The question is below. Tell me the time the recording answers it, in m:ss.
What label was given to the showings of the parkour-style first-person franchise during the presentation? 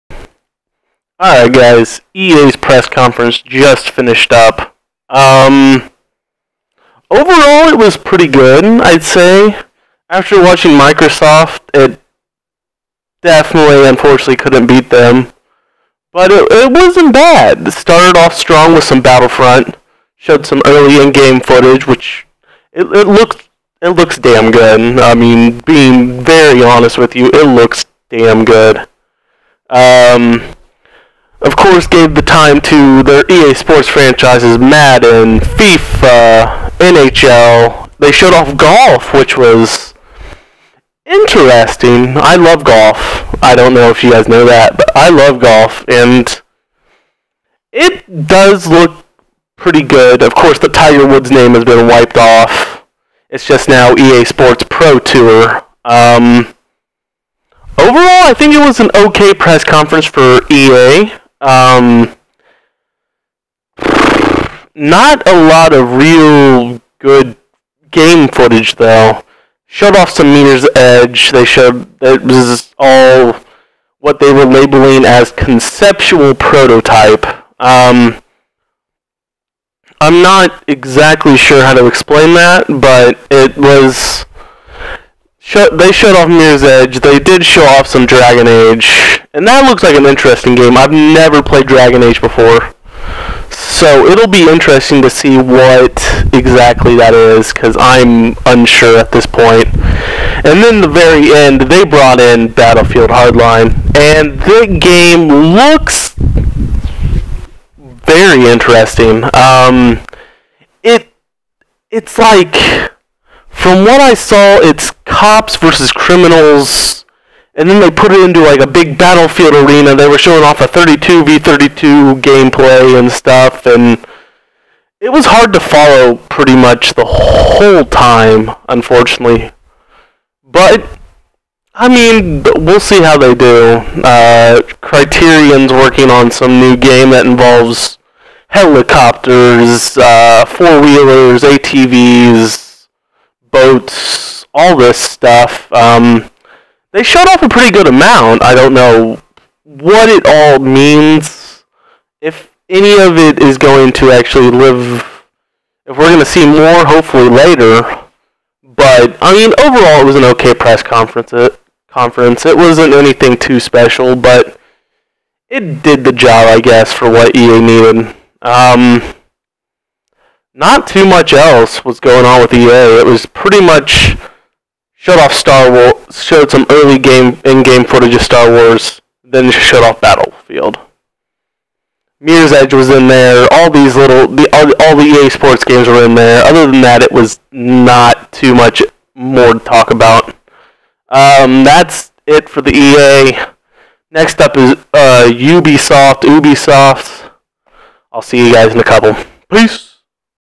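1:15.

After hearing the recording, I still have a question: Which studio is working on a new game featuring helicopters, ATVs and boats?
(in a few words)
Criterion.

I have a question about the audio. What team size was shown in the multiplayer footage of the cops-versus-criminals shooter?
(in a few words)
32 v 32.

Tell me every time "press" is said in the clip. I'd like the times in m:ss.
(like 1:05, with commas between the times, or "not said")
0:02, 0:59, 2:40.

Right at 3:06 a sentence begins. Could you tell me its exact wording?
Other than that, it was not too much more to talk about.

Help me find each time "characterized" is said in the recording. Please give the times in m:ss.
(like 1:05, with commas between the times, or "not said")
not said.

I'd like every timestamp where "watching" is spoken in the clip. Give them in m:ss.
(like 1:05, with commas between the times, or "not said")
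0:10.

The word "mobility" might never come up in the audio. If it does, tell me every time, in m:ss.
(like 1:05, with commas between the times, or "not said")
not said.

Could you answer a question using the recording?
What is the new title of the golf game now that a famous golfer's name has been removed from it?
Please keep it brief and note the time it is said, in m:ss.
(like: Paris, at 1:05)
EA Sports Pro Tour, at 0:53.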